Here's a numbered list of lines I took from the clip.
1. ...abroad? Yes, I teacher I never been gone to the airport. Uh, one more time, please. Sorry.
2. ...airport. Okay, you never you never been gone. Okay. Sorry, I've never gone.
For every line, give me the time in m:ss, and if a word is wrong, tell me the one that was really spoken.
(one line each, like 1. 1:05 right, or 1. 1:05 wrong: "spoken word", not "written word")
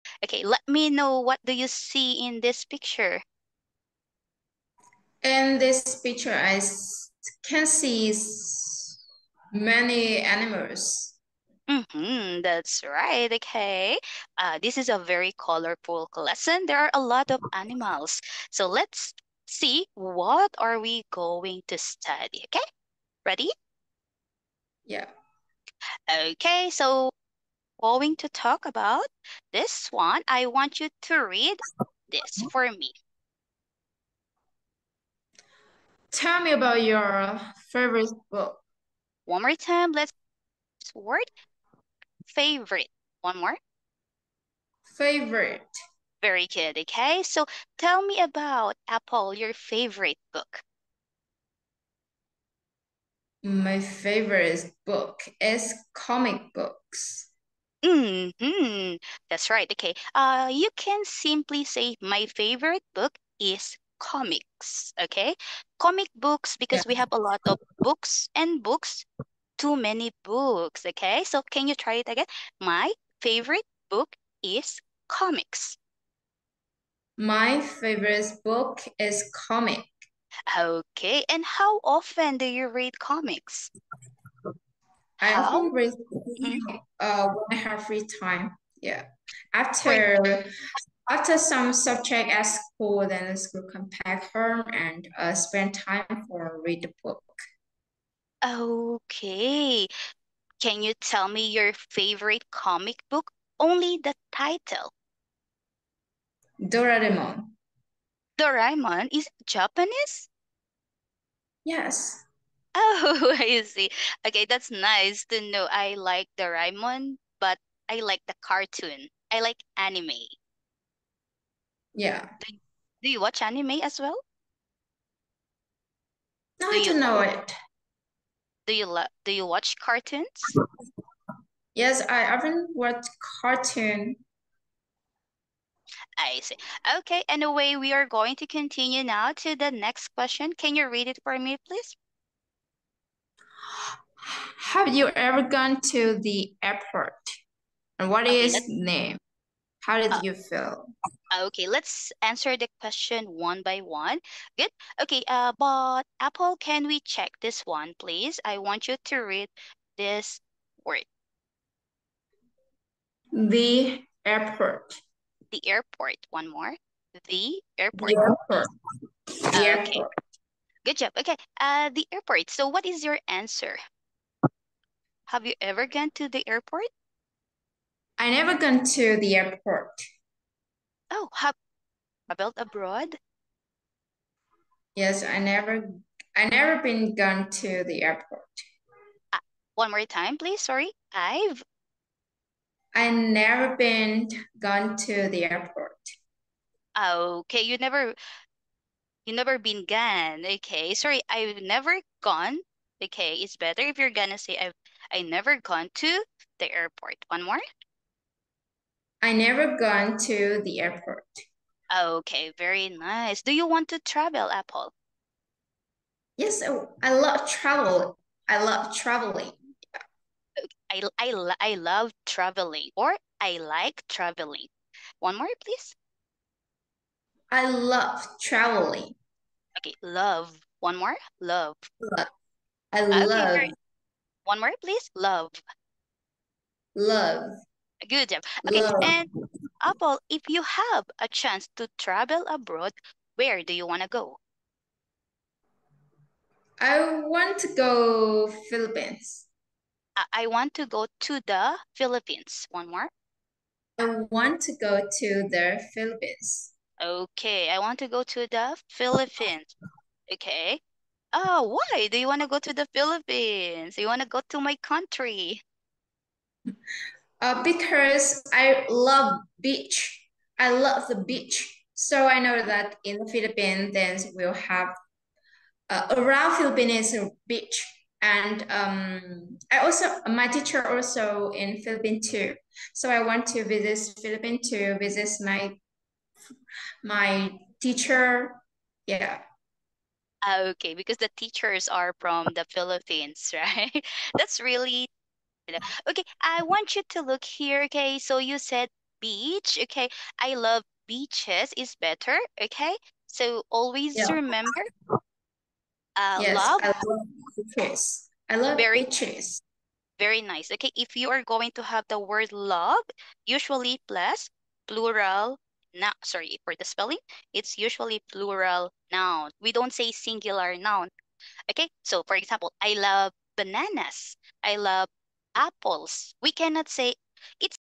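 1. 3:02 wrong: "never", not "teacher"
2. 3:15 right.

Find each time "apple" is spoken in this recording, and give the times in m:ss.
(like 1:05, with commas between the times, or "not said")
0:48, 2:36, 3:34, 3:59, 5:25.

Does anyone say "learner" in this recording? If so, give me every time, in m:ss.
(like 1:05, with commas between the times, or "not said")
not said.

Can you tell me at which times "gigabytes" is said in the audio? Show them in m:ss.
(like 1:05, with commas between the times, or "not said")
not said.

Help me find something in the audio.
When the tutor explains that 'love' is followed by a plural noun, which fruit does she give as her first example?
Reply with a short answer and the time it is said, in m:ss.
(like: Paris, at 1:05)
bananas, at 5:22.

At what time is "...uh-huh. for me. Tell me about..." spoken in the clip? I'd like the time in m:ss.
0:32.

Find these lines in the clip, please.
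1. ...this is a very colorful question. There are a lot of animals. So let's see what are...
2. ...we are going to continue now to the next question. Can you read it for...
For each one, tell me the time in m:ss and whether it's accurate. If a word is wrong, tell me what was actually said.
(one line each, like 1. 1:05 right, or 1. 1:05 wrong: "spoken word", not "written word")
1. 0:14 wrong: "lesson", not "question"
2. 2:17 right.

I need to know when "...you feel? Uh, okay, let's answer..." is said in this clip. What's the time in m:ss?
2:30.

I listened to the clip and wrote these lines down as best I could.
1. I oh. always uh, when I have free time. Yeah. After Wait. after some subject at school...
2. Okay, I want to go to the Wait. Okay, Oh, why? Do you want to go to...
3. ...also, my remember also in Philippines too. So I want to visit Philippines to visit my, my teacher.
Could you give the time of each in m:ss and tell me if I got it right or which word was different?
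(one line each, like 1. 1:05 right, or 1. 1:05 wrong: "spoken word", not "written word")
1. 1:25 right
2. 4:17 wrong: "Philippines", not "Wait"
3. 4:39 wrong: "teacher", not "remember".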